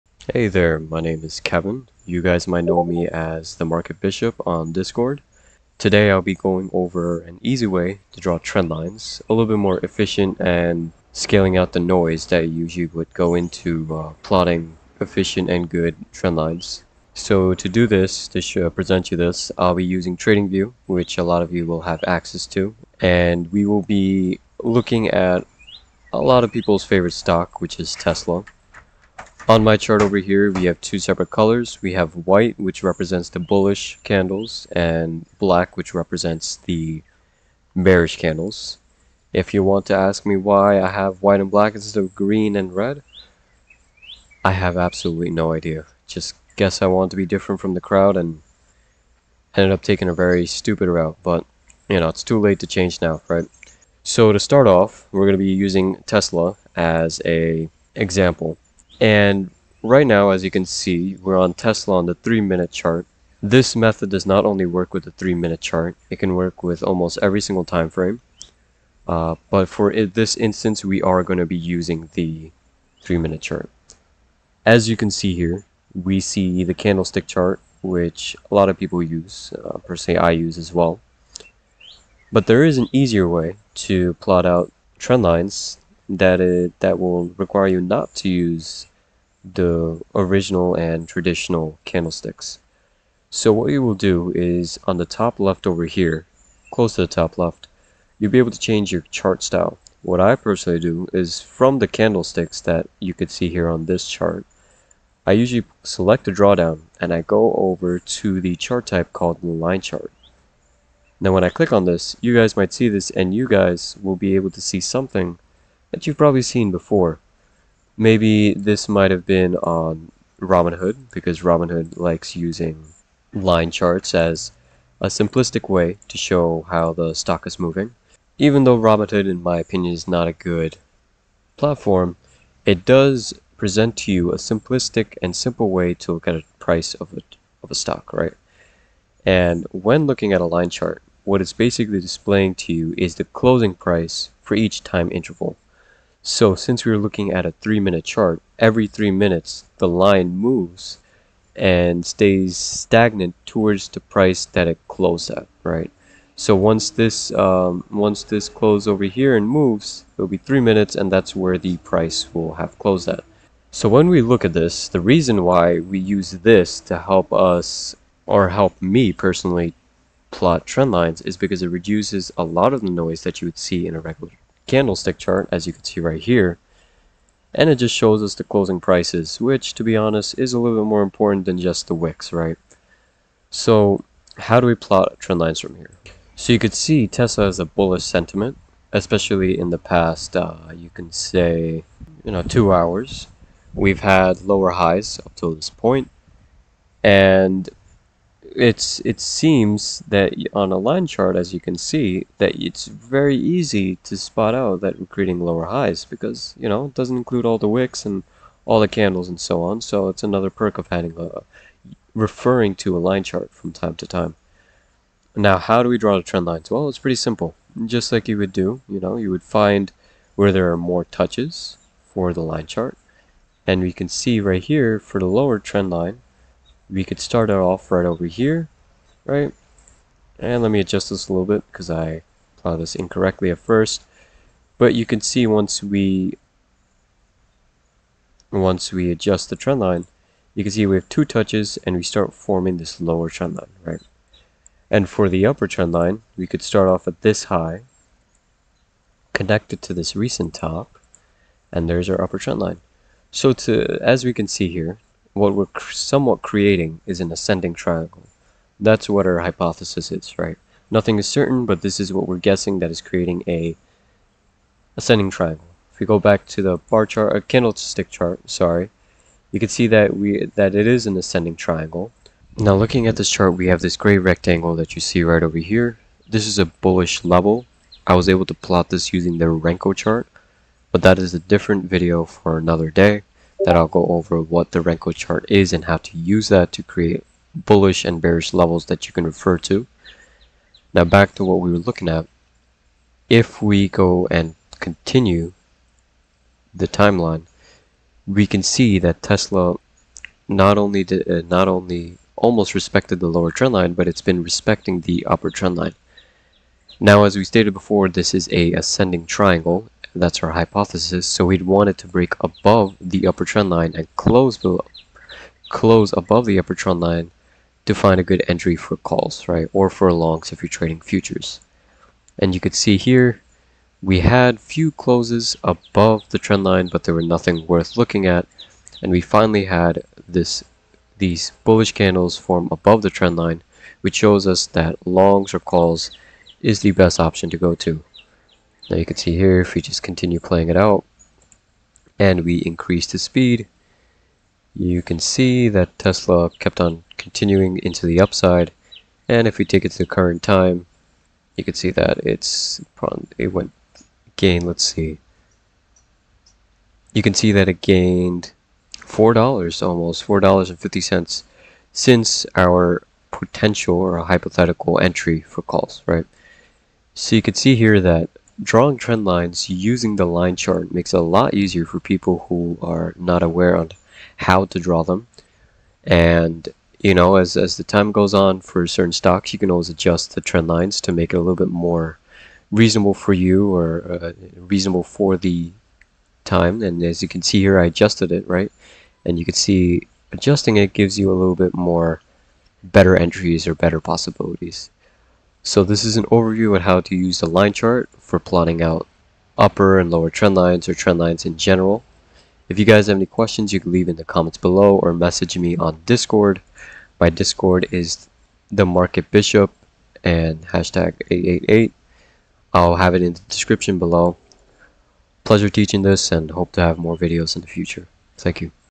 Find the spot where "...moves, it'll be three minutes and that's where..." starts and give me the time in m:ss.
2:39.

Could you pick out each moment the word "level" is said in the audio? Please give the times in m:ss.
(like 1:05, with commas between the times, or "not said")
4:37, 4:48.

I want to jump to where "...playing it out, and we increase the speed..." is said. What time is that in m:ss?
5:40.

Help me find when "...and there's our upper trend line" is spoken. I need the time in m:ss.
4:11.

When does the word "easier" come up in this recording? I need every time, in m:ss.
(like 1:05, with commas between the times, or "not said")
1:22, 6:11.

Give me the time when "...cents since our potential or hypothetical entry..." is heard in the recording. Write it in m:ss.
6:00.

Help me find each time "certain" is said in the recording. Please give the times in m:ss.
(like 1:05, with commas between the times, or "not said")
4:21, 6:18.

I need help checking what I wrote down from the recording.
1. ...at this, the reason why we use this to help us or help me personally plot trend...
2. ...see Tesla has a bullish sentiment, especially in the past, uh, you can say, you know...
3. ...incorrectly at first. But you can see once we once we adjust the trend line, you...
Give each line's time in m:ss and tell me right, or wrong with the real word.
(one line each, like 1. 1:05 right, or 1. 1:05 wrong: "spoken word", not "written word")
1. 2:44 right
2. 3:06 right
3. 3:52 right.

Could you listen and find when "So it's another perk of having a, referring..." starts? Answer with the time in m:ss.
3:29.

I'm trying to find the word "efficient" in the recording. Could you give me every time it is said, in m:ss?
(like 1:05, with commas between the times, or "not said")
0:09, 0:15.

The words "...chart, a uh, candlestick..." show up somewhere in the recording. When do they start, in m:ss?
4:27.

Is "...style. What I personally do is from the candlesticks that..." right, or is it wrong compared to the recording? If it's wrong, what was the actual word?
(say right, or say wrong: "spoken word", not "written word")
right.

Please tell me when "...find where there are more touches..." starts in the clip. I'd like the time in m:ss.
3:39.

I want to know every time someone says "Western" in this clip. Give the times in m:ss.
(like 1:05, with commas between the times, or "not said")
not said.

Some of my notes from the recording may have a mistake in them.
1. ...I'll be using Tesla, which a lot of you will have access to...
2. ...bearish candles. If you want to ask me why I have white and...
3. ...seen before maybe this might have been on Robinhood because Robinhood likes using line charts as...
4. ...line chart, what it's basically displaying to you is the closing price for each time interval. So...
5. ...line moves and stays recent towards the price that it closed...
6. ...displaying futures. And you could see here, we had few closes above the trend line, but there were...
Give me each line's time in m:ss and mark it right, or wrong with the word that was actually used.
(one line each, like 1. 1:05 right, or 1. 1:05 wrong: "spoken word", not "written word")
1. 0:19 wrong: "TradingView", not "Tesla"
2. 0:37 right
3. 1:56 right
4. 2:20 right
5. 2:29 wrong: "stagnant", not "recent"
6. 5:20 wrong: "trading", not "displaying".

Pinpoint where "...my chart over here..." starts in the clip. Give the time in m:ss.
0:29.